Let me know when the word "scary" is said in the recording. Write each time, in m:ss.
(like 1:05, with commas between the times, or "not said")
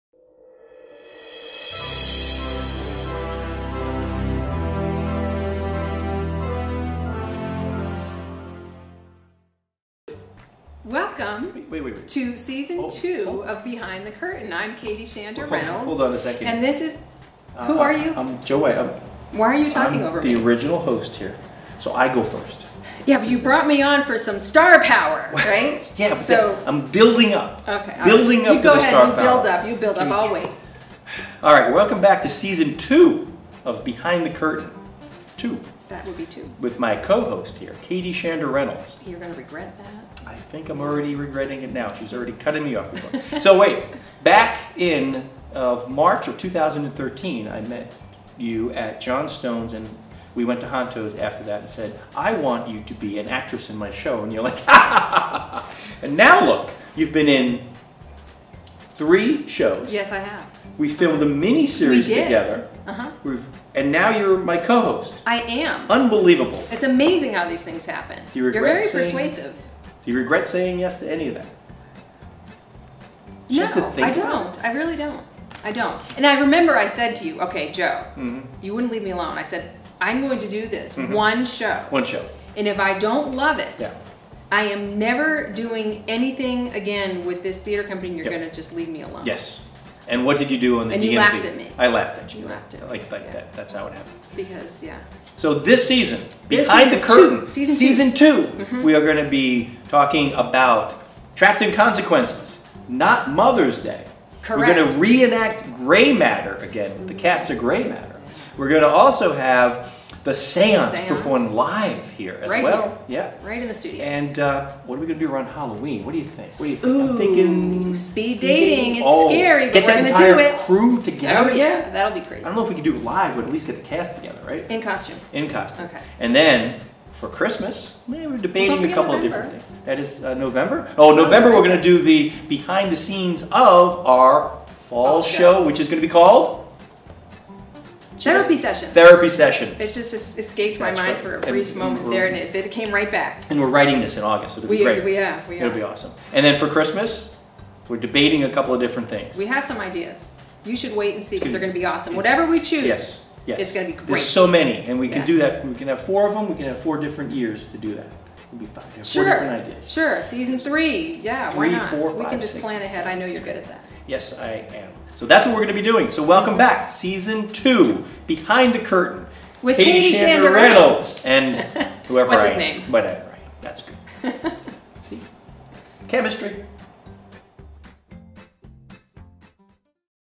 1:59.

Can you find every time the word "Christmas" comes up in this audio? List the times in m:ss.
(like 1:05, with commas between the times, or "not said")
2:07, 2:26.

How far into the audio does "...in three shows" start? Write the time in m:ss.
0:57.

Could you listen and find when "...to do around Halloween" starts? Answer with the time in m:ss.
1:55.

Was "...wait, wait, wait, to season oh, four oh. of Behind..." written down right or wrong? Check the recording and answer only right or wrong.
wrong.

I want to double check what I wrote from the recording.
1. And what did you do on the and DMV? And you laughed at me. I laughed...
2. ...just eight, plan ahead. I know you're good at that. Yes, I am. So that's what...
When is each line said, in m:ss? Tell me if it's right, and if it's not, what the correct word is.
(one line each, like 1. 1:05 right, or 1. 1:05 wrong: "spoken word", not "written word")
1. 1:30 right
2. 2:42 wrong: "six", not "eight".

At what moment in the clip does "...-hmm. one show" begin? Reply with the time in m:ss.
1:21.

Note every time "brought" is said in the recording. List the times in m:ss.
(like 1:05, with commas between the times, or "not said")
0:23.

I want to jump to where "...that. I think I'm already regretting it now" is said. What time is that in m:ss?
0:39.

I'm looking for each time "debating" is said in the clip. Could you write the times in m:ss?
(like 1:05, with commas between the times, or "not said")
2:08, 2:27.